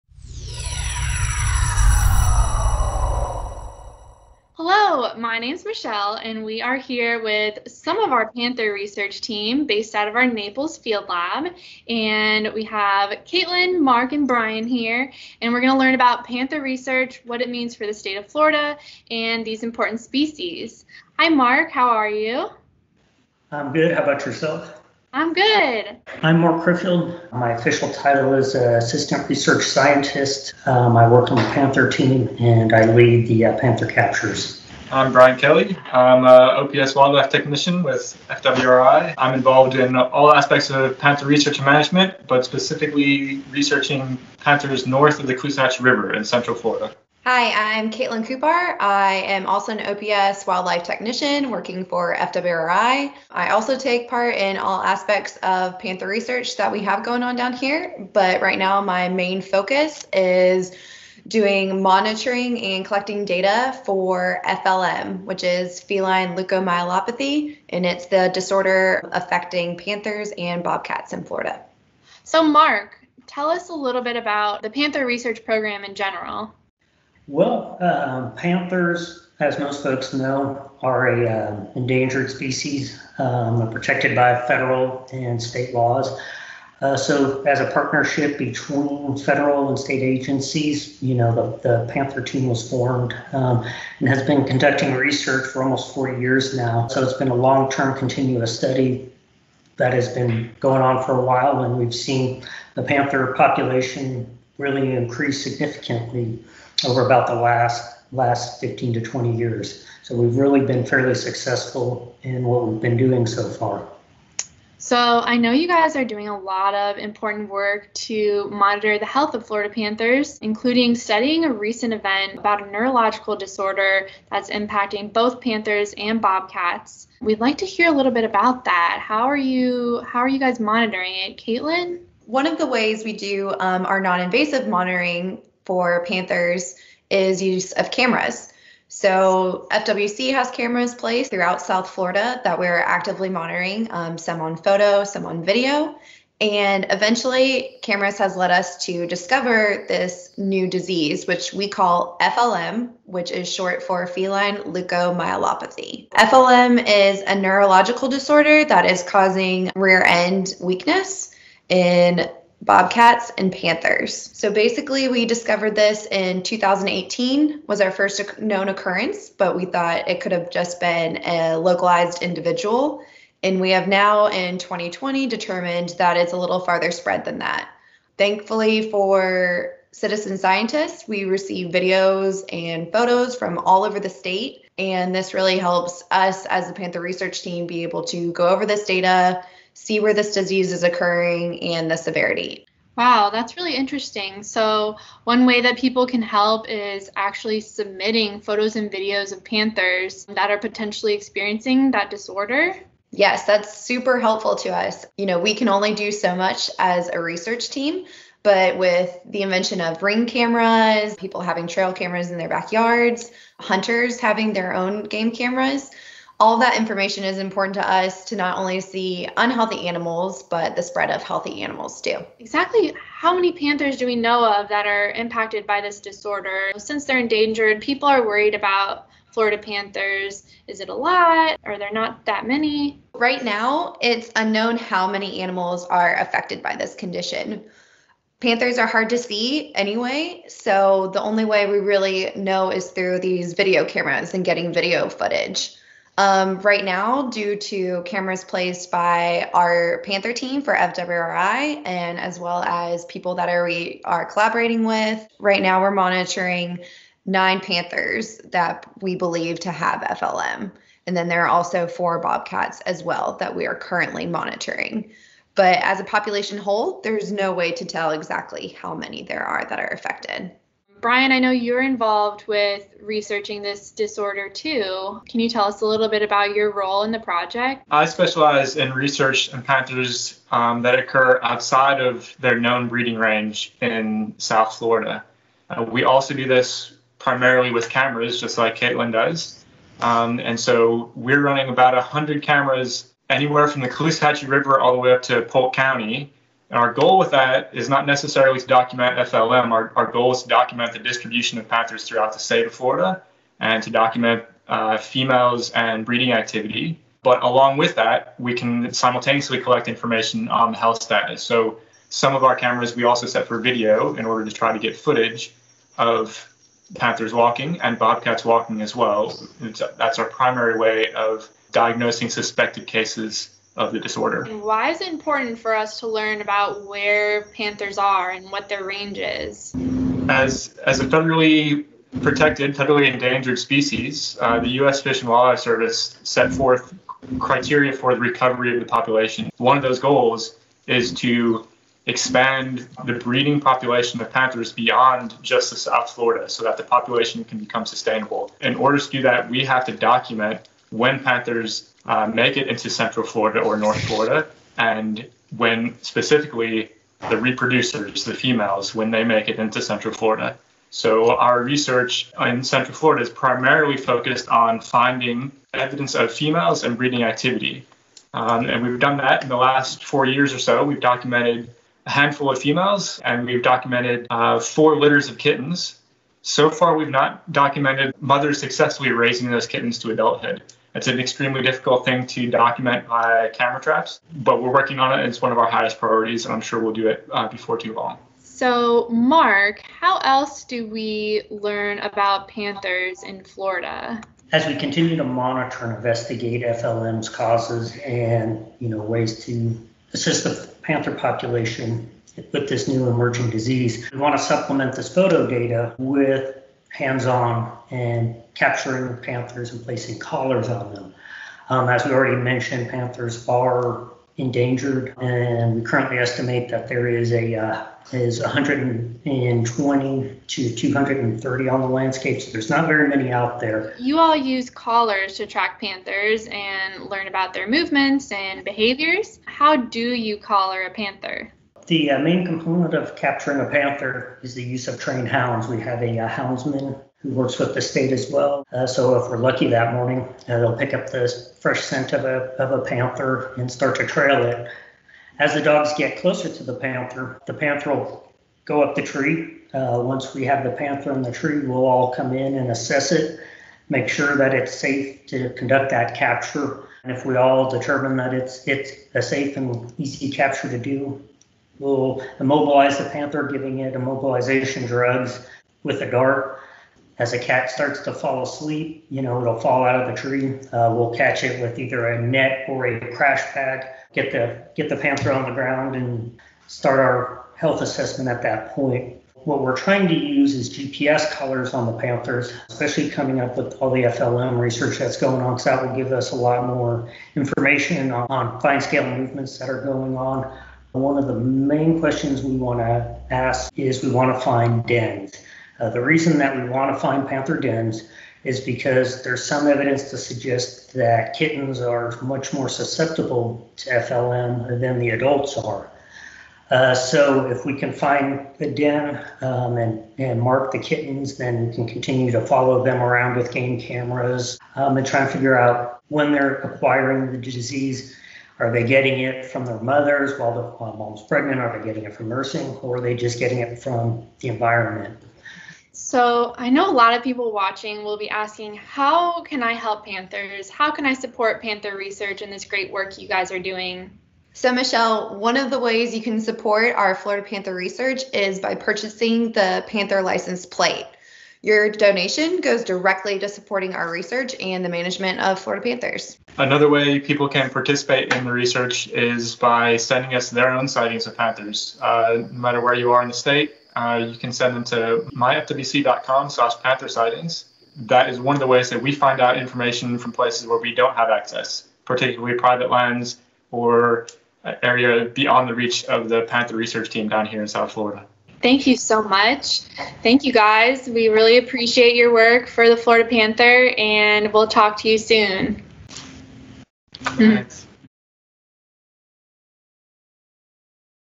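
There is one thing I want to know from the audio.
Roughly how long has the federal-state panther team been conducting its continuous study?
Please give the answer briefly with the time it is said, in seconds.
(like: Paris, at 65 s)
almost 40 years, at 95 s.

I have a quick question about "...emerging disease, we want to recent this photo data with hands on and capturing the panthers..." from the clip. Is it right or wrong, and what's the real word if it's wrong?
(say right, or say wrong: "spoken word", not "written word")
wrong: "supplement", not "recent".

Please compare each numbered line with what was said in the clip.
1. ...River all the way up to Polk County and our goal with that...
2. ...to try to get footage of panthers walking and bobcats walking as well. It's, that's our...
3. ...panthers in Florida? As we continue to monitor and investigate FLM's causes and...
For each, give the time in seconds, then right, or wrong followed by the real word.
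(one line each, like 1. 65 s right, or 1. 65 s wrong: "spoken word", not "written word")
1. 294 s right
2. 314 s right
3. 392 s right.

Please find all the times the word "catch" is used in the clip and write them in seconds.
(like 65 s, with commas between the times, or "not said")
471 s.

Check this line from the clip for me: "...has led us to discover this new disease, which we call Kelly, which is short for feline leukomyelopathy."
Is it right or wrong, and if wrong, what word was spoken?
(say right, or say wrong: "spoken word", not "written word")
wrong: "FLM", not "Kelly".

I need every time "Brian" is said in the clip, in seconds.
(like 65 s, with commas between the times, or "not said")
14 s, 35 s, 271 s.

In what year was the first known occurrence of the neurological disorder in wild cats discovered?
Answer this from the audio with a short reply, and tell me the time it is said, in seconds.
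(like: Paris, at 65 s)
2018, at 166 s.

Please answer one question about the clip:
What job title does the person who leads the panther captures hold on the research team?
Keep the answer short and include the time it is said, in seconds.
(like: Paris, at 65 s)
Assistant Research Scientist, at 28 s.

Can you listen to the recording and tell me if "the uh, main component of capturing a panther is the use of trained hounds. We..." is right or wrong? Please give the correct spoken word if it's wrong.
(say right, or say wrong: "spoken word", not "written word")
right.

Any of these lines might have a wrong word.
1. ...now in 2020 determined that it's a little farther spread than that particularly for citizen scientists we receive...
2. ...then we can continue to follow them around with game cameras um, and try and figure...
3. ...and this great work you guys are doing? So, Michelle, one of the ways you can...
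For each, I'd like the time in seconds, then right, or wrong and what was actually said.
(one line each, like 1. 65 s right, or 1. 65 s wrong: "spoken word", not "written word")
1. 173 s wrong: "thankfully", not "particularly"
2. 511 s right
3. 532 s right.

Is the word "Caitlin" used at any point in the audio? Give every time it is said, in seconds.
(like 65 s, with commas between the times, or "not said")
13 s, 47 s, 131 s, 288 s.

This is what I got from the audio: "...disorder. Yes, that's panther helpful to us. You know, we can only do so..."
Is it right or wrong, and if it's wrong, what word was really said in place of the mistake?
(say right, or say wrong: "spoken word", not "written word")
wrong: "super", not "panther".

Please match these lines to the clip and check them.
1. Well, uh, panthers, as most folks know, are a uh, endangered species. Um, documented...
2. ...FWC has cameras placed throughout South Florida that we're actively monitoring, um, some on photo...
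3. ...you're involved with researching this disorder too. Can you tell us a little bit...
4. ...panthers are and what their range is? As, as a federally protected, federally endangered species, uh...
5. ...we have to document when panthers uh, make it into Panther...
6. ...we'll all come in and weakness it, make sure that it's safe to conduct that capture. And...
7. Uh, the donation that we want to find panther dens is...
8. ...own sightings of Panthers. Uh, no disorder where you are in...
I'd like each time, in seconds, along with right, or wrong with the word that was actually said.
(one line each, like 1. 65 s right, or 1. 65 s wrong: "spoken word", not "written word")
1. 77 s wrong: "protected", not "documented"
2. 139 s right
3. 271 s right
4. 327 s right
5. 349 s wrong: "Central", not "Panther"
6. 451 s wrong: "assess", not "weakness"
7. 495 s wrong: "reason", not "donation"
8. 550 s wrong: "matter", not "disorder".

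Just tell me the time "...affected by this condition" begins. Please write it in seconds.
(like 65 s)
236 s.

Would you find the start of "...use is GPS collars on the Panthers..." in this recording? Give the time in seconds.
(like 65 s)
480 s.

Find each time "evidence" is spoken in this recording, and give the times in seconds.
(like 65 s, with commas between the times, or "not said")
365 s, 499 s.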